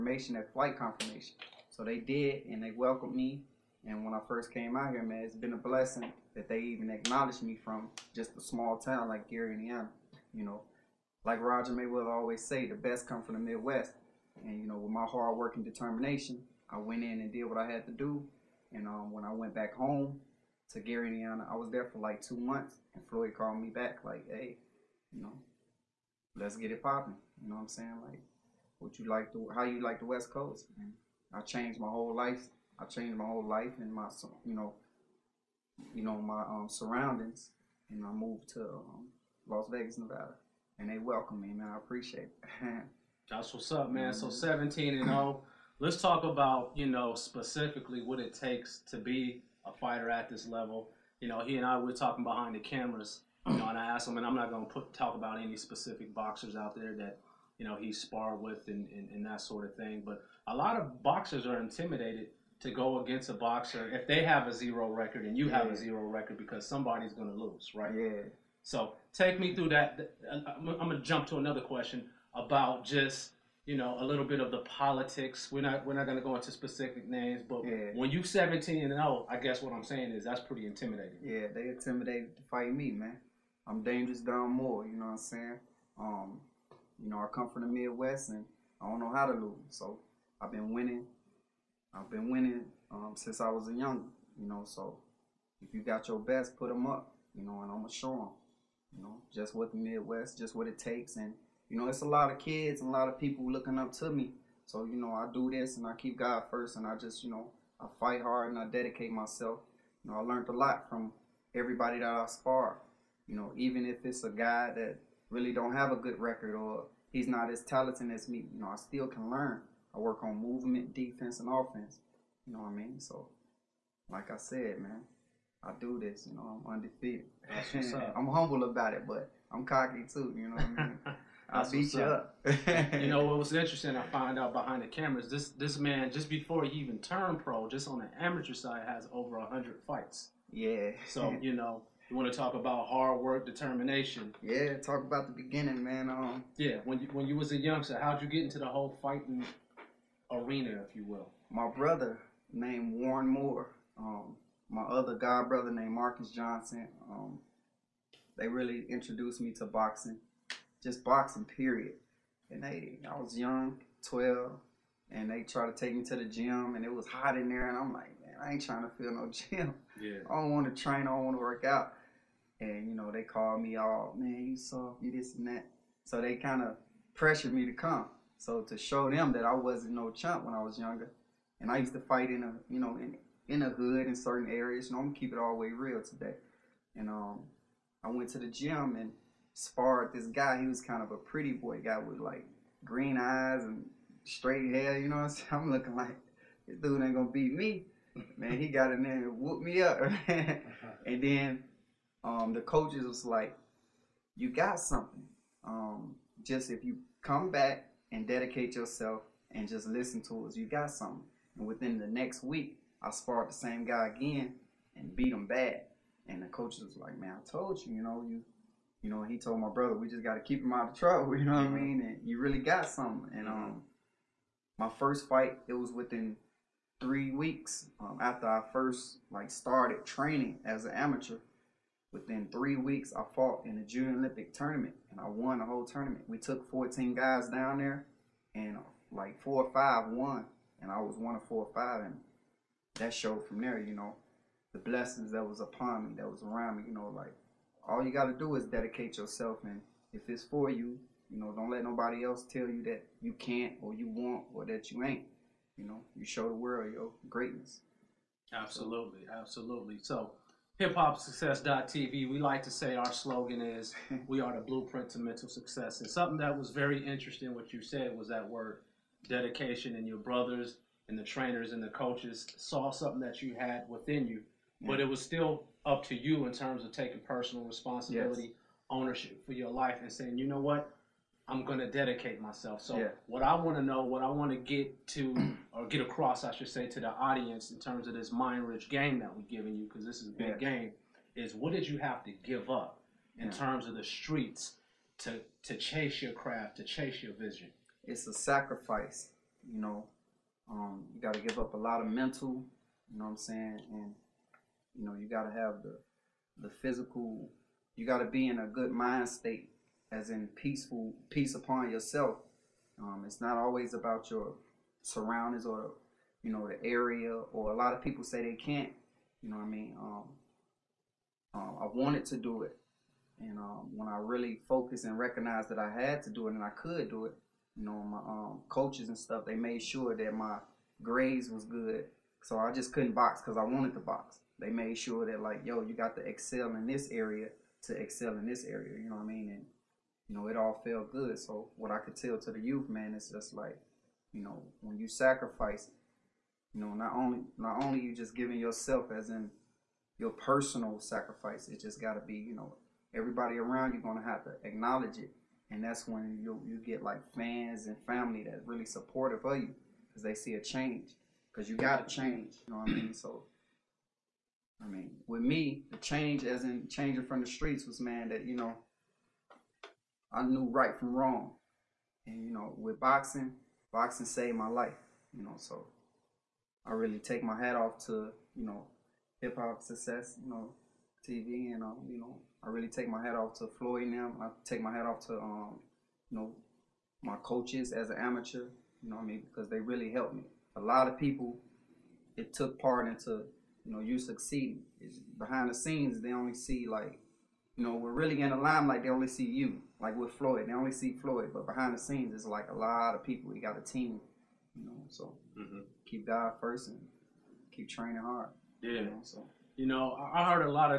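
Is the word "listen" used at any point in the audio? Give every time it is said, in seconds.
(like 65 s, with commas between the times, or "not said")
209 s.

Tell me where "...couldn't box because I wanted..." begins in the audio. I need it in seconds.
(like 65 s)
332 s.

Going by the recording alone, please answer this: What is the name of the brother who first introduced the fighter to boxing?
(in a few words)
Warren Moore.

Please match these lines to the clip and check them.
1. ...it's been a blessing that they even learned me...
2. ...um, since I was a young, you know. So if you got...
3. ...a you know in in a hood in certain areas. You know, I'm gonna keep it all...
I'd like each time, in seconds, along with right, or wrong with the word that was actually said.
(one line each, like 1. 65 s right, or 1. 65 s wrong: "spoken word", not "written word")
1. 5 s wrong: "acknowledged", not "learned"
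2. 92 s right
3. 182 s right.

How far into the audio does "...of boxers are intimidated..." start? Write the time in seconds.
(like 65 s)
60 s.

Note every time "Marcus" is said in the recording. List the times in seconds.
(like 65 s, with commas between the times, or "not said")
155 s.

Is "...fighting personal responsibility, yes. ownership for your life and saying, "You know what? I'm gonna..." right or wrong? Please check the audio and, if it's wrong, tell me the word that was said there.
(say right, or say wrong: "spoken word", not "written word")
wrong: "taking", not "fighting".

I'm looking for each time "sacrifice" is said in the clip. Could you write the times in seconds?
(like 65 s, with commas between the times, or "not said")
298 s, 345 s, 351 s.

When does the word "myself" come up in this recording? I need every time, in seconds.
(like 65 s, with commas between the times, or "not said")
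109 s, 282 s.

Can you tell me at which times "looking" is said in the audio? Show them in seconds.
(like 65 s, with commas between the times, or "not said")
103 s, 195 s.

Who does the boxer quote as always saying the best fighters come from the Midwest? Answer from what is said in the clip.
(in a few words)
Roger Mayweather.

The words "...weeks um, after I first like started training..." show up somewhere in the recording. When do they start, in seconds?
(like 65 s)
227 s.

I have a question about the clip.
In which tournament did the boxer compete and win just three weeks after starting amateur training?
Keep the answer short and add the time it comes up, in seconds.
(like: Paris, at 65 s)
Junior Olympic, at 233 s.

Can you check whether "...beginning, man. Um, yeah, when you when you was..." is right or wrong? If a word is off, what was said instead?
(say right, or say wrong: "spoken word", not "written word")
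right.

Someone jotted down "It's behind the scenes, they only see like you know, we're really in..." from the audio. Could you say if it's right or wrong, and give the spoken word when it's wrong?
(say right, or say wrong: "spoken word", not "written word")
right.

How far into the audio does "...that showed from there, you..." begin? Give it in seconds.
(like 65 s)
242 s.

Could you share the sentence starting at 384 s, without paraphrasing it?
I take my hat off to um, you know, my coaches as an amateur.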